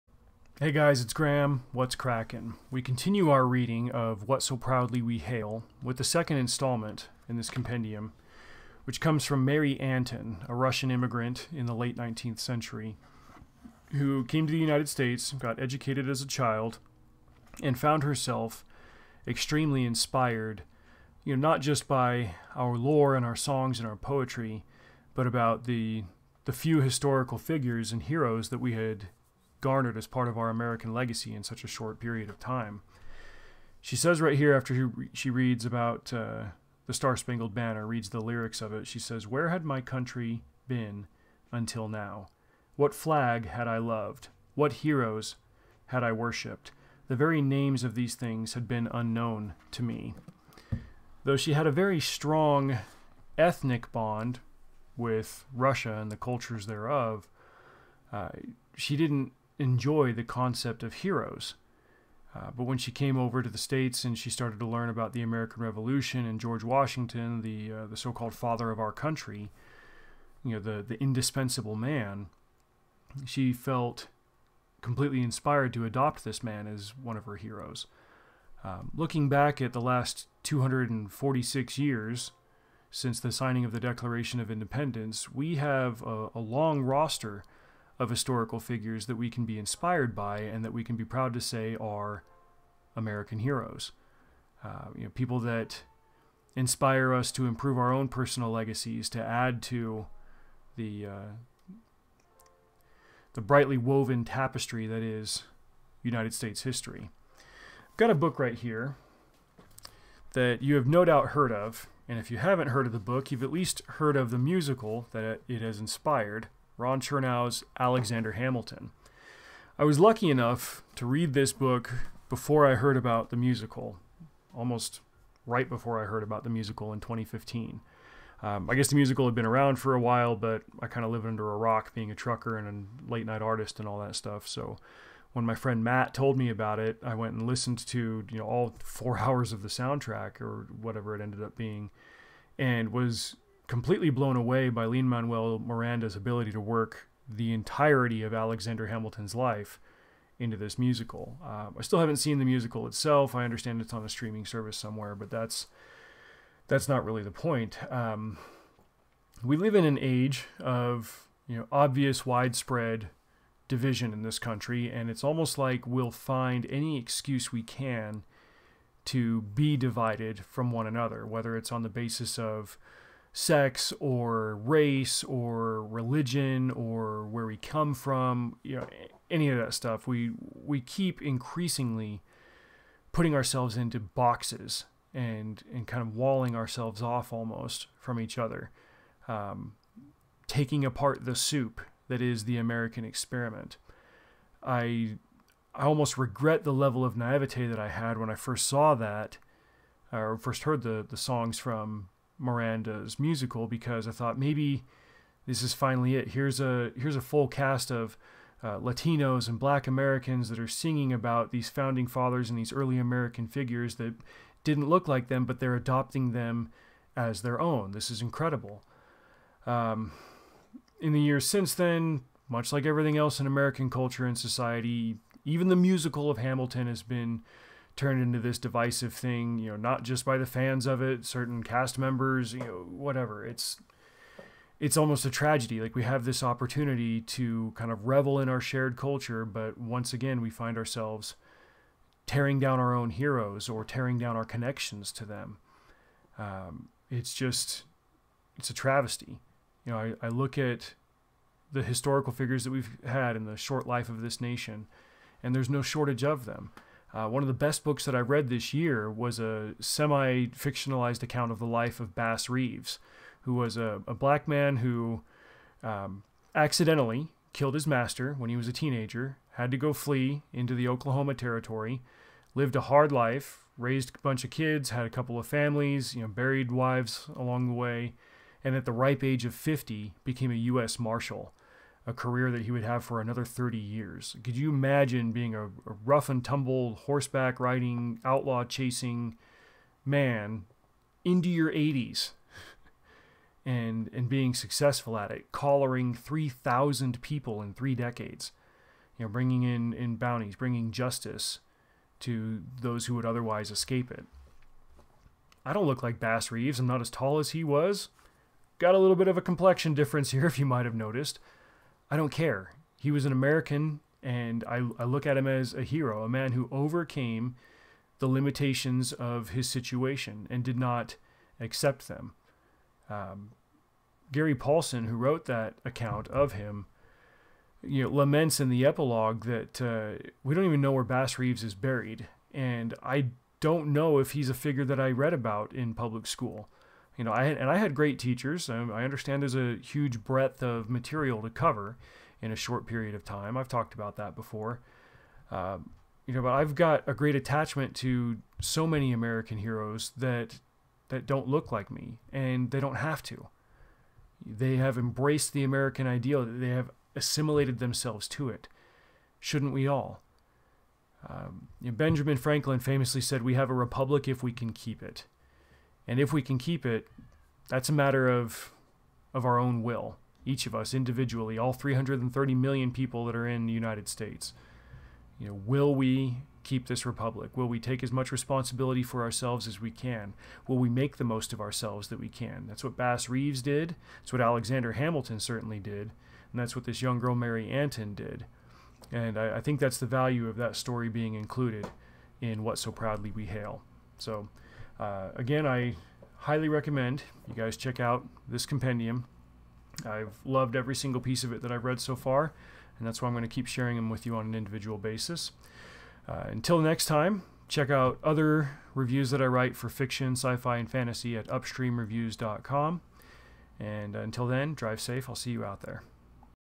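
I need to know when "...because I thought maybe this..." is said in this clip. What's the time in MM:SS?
03:23.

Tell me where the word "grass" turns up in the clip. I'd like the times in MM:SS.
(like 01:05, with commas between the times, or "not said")
not said.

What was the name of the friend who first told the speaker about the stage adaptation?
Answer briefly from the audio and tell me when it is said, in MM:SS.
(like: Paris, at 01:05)
Matt, at 02:15.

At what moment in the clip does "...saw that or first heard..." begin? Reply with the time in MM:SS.
03:18.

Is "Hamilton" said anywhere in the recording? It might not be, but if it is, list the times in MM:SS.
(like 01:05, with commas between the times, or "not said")
01:58, 02:28, 03:46, 06:24.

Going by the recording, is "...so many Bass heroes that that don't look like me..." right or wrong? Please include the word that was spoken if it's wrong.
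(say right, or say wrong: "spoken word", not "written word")
wrong: "American", not "Bass".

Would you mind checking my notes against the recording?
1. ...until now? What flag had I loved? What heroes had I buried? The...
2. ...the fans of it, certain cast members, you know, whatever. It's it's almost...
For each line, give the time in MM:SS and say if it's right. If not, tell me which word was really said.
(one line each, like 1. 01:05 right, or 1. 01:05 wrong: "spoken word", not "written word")
1. 00:41 wrong: "worshipped", not "buried"
2. 03:50 right.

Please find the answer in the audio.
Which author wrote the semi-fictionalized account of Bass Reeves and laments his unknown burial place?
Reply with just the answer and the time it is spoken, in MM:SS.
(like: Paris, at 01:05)
Gary Paulsen, at 05:24.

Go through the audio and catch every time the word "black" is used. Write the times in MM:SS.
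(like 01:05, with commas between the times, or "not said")
03:29, 04:24.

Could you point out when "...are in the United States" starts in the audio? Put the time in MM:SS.
06:13.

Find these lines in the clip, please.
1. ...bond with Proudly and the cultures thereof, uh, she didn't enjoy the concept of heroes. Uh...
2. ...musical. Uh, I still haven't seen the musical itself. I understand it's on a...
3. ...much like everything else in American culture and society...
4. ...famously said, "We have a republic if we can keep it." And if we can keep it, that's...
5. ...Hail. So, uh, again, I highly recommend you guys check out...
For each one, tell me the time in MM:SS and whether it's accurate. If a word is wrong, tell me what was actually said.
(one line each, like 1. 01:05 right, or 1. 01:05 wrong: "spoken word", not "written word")
1. 00:53 wrong: "Russia", not "Proudly"
2. 02:30 right
3. 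03:42 right
4. 06:02 right
5. 06:33 right.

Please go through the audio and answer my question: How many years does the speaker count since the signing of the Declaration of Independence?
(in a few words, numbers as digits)
246.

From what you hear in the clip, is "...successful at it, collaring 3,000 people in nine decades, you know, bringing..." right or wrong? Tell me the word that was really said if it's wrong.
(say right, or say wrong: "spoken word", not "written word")
wrong: "three", not "nine".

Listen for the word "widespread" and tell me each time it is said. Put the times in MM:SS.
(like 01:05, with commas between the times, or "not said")
02:42.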